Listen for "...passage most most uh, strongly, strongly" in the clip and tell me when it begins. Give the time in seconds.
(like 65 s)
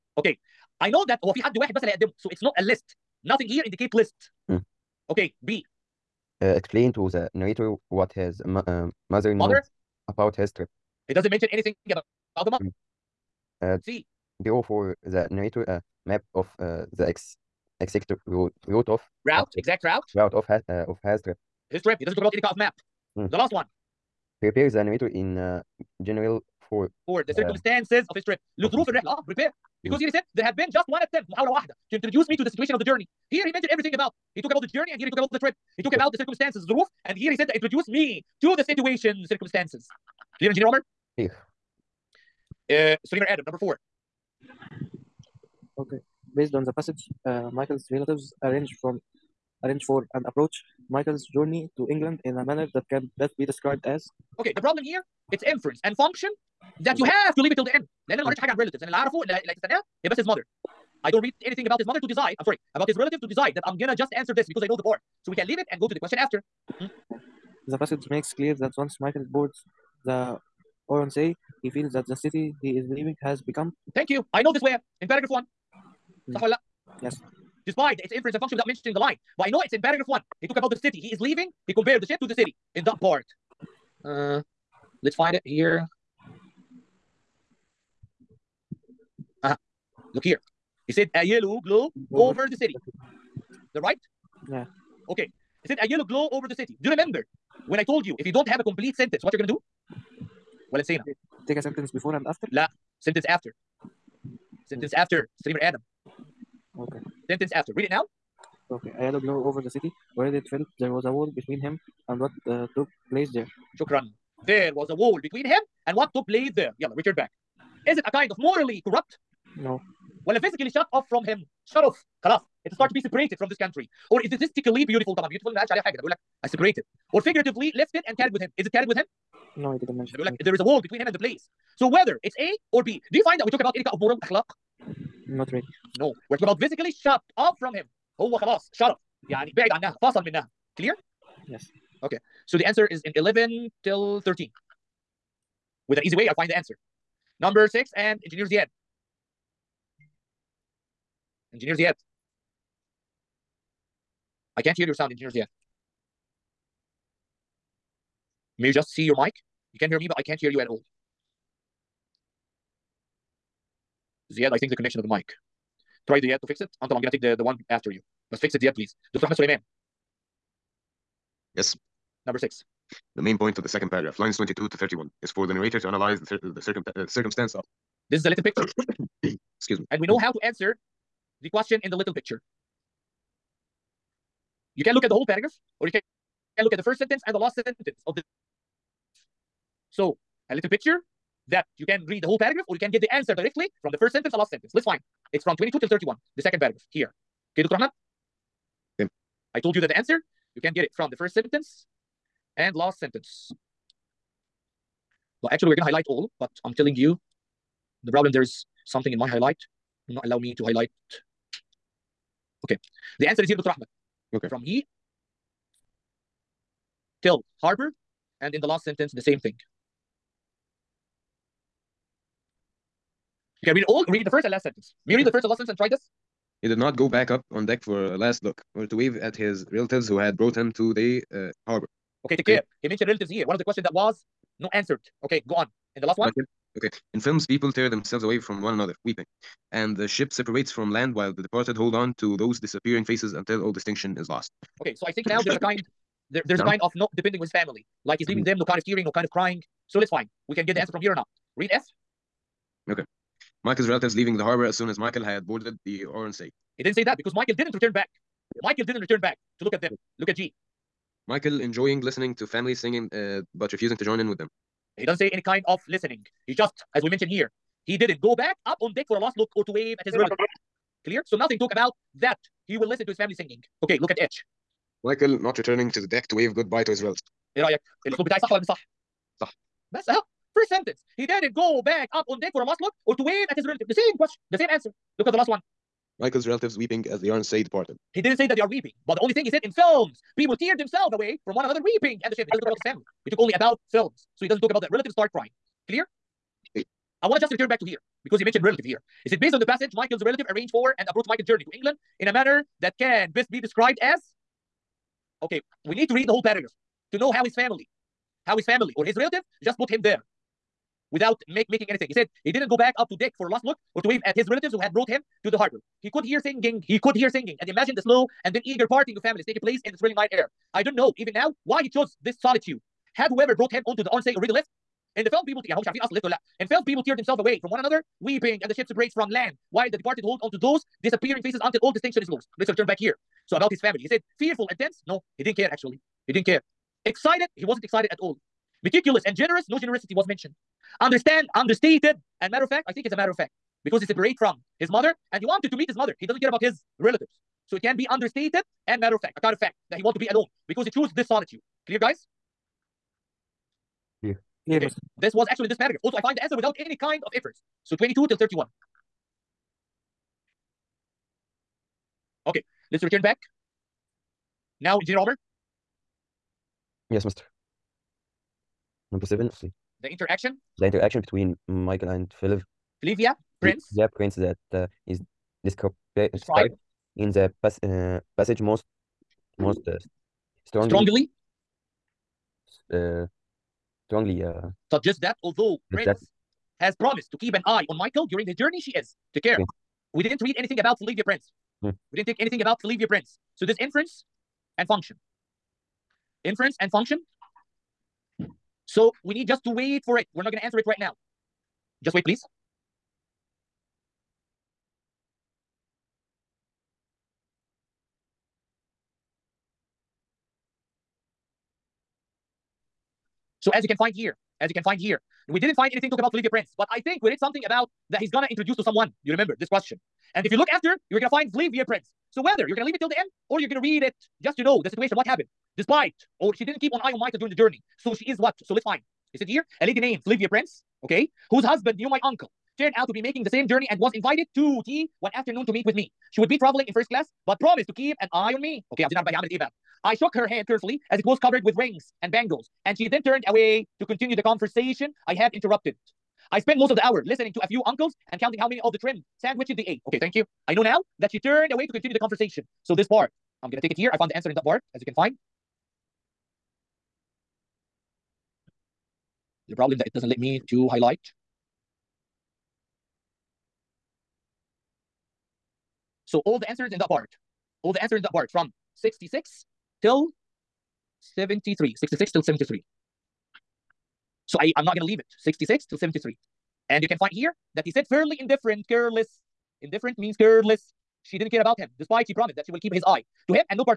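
378 s.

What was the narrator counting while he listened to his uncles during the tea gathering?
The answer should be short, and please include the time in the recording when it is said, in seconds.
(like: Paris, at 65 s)
trimmed sandwiches, at 448 s.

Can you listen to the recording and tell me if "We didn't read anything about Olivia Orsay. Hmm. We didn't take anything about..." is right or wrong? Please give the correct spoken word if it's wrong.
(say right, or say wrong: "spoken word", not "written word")
wrong: "Prince", not "Orsay".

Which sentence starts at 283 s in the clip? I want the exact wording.
The same question, the same answer.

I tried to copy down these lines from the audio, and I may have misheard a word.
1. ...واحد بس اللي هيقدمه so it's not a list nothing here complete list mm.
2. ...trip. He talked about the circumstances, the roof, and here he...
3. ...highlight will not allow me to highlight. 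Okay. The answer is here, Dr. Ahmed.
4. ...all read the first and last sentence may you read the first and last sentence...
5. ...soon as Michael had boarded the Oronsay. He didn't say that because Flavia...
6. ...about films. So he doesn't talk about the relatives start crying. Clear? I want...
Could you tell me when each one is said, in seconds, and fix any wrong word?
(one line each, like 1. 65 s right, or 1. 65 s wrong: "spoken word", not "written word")
1. 1 s wrong: "indicate", not "complete"
2. 35 s right
3. 209 s right
4. 223 s right
5. 254 s wrong: "Michael", not "Flavia"
6. 293 s right.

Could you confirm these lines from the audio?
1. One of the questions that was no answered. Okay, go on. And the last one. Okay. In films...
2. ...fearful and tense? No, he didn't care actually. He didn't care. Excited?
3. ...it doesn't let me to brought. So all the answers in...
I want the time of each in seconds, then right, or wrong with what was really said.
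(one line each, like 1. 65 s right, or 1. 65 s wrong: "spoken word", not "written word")
1. 233 s right
2. 334 s right
3. 460 s wrong: "highlight", not "brought".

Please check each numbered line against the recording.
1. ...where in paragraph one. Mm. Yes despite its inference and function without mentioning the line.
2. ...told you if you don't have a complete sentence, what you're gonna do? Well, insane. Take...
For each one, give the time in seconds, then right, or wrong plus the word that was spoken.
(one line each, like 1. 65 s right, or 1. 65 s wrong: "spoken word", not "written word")
1. 74 s right
2. 97 s right.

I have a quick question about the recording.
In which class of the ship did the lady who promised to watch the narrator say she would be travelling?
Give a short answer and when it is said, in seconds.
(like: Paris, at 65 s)
first class, at 436 s.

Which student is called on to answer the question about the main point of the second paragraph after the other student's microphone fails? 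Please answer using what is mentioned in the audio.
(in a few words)
Ahmed Suleiman.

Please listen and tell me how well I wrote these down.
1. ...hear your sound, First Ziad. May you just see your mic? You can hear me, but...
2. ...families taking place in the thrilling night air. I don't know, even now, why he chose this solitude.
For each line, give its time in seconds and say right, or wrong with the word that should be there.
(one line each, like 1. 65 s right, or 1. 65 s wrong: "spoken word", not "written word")
1. 154 s wrong: "Engineer", not "First"
2. 319 s right.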